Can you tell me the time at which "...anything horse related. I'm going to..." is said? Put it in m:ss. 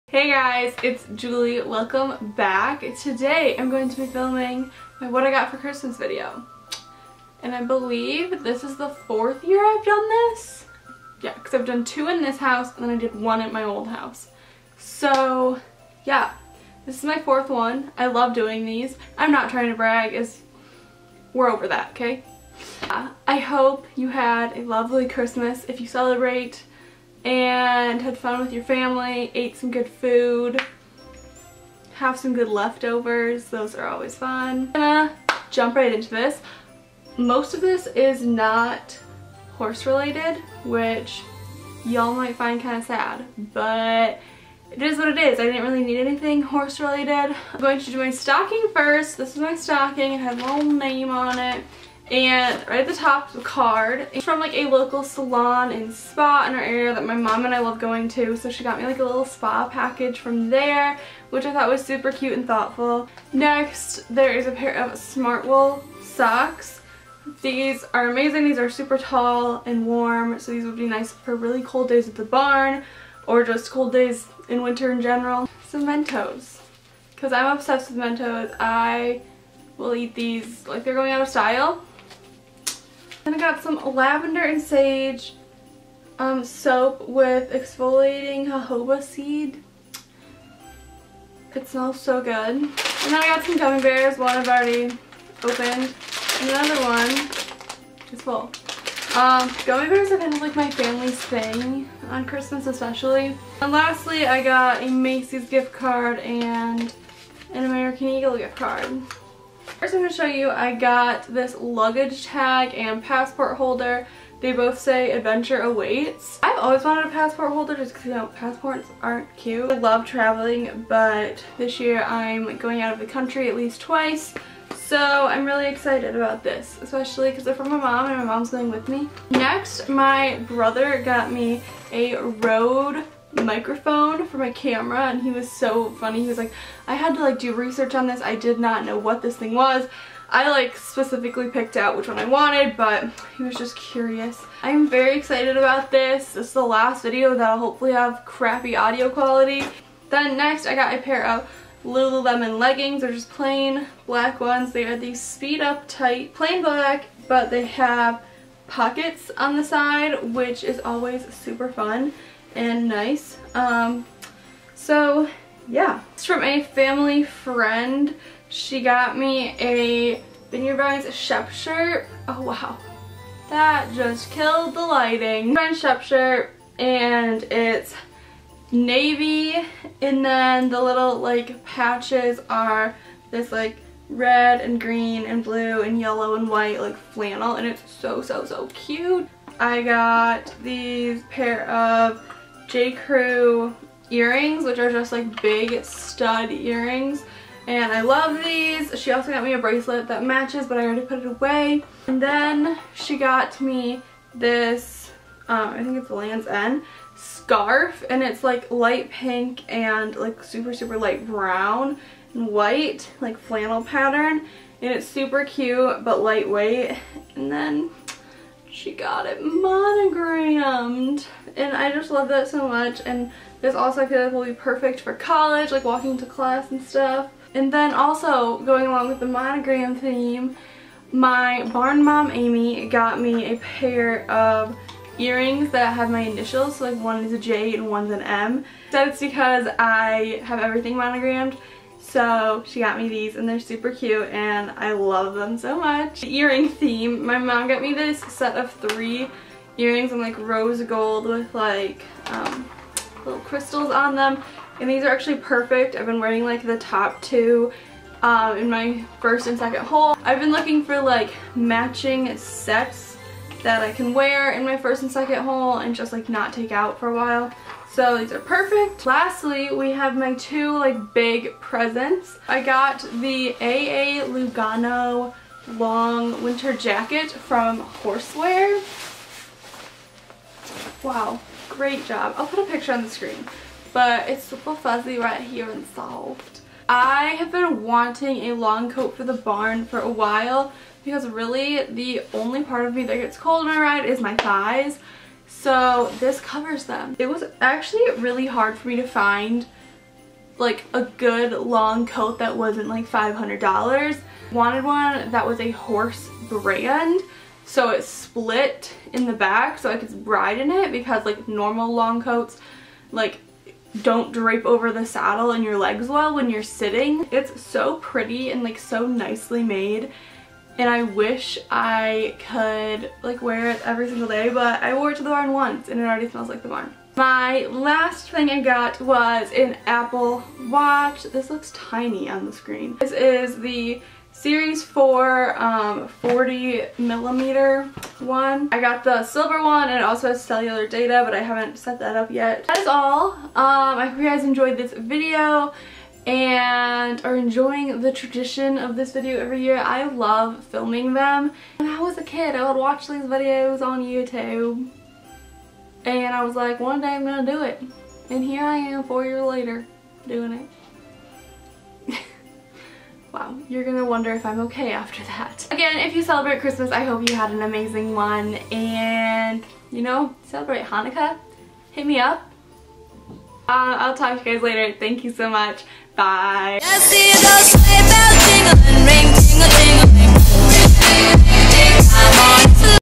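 0:45.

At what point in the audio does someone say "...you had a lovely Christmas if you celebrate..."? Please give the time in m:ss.
0:23.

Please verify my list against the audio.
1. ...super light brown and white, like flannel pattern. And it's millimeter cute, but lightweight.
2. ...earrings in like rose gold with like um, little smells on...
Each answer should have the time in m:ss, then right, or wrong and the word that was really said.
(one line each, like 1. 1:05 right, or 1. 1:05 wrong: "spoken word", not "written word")
1. 3:30 wrong: "super", not "millimeter"
2. 4:09 wrong: "crystals", not "smells".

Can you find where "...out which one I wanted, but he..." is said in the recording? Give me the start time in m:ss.
2:21.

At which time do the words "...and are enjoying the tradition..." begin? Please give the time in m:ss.
5:46.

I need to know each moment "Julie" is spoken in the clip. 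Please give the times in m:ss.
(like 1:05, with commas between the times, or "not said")
0:01.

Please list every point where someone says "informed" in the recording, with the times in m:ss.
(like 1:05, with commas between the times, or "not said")
not said.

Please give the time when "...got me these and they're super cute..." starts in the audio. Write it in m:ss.
4:02.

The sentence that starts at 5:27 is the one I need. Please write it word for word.
My last thing I got was an Apple Watch.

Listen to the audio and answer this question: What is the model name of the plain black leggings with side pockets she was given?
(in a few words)
Speed Up Tight.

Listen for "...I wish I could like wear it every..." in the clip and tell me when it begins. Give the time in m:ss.
5:20.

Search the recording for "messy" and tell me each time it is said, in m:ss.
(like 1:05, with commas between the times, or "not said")
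not said.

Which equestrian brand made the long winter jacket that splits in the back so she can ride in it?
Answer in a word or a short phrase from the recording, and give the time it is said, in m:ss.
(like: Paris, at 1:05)
Horseware, at 4:38.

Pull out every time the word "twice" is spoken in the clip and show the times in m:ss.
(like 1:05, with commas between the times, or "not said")
2:03.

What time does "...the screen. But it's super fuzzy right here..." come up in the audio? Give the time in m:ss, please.
4:43.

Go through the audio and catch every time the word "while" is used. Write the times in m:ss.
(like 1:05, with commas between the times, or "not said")
4:27, 4:50.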